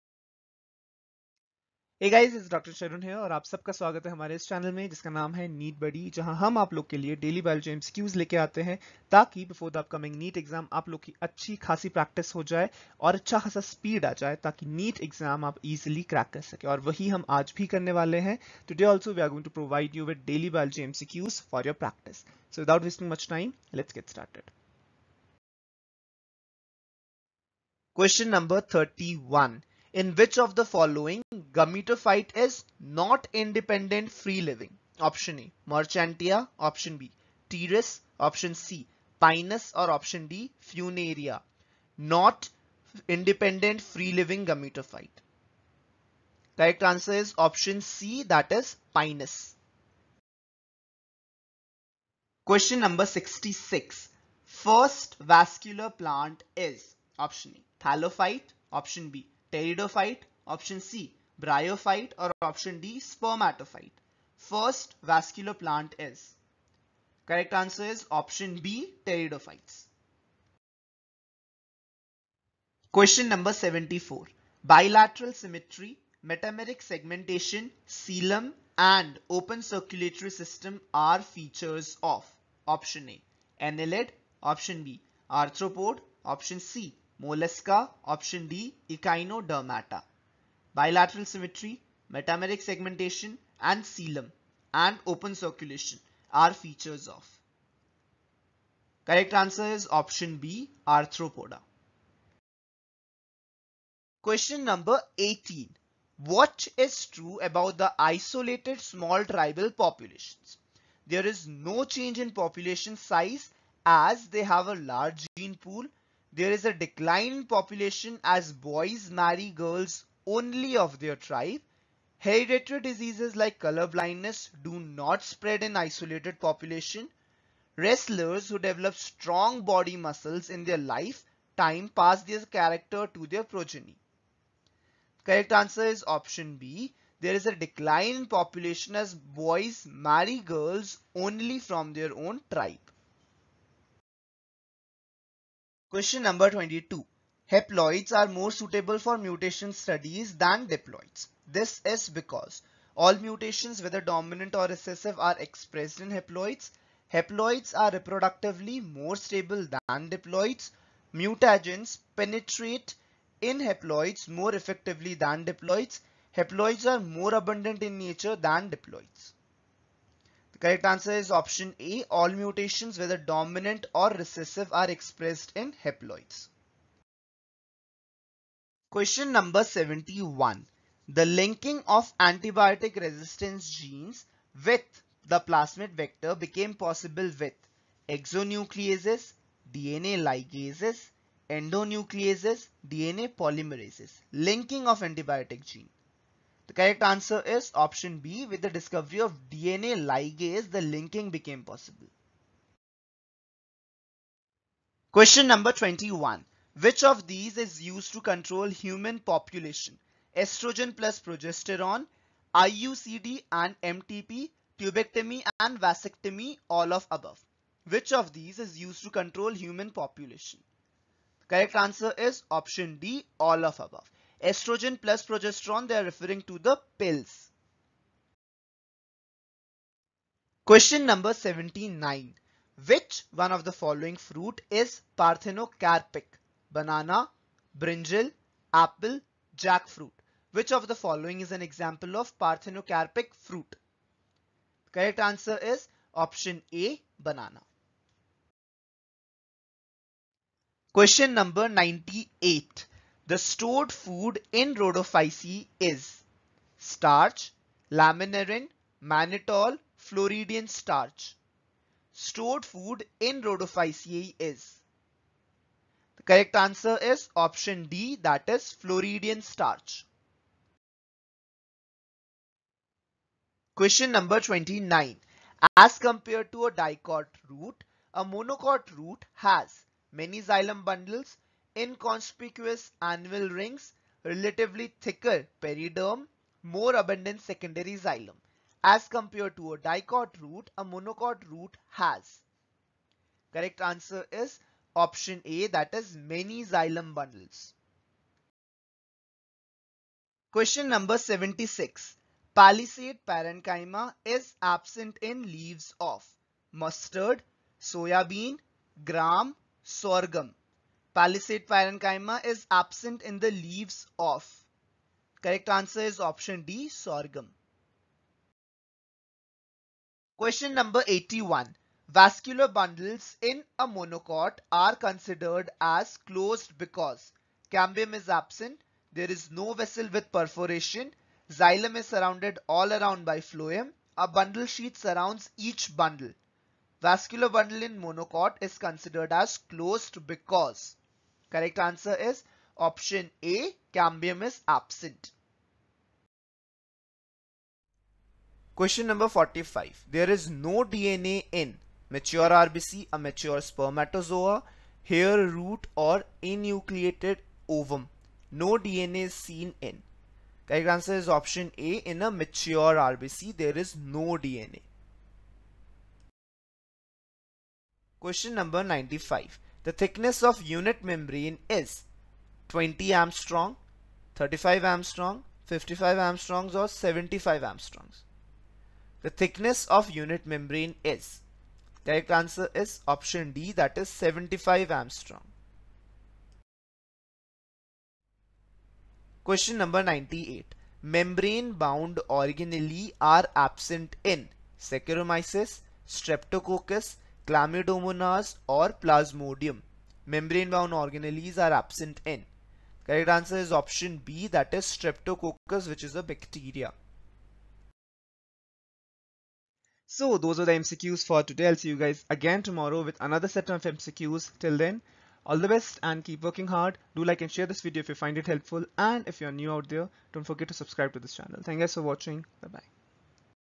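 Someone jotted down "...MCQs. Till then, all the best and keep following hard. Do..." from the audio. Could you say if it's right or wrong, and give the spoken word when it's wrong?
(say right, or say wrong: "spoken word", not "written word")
wrong: "working", not "following".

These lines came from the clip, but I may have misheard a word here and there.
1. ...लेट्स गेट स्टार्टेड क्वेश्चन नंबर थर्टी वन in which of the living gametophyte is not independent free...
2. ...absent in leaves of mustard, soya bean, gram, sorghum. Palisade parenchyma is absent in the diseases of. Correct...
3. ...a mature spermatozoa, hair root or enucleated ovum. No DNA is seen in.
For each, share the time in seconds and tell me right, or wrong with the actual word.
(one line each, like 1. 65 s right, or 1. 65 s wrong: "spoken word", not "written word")
1. 23 s wrong: "following", not "living"
2. 304 s wrong: "leaves", not "diseases"
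3. 353 s right.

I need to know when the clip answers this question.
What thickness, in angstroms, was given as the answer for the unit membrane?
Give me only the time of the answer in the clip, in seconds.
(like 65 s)
384 s.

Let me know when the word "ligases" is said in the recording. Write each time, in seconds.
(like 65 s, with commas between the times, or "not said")
190 s, 200 s.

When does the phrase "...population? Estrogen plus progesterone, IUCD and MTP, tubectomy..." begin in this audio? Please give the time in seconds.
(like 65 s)
209 s.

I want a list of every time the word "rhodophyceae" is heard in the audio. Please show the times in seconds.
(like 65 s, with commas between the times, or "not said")
254 s, 263 s.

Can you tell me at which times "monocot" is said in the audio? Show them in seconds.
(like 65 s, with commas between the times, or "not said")
278 s, 290 s, 323 s, 337 s.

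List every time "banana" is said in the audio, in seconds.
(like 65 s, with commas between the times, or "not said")
236 s, 247 s.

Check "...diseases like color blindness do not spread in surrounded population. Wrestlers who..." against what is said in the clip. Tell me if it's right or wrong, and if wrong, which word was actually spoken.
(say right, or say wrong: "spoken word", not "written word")
wrong: "isolated", not "surrounded".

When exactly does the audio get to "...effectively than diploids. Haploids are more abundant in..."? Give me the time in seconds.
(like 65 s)
164 s.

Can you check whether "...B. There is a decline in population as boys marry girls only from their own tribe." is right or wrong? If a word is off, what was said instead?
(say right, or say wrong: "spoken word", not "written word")
right.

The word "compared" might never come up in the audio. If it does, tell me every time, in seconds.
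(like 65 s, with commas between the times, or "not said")
275 s, 289 s.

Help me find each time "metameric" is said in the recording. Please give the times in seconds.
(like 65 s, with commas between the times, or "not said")
76 s, 92 s.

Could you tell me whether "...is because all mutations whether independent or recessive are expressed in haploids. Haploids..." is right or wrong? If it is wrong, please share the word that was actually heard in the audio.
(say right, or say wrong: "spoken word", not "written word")
wrong: "dominant", not "independent".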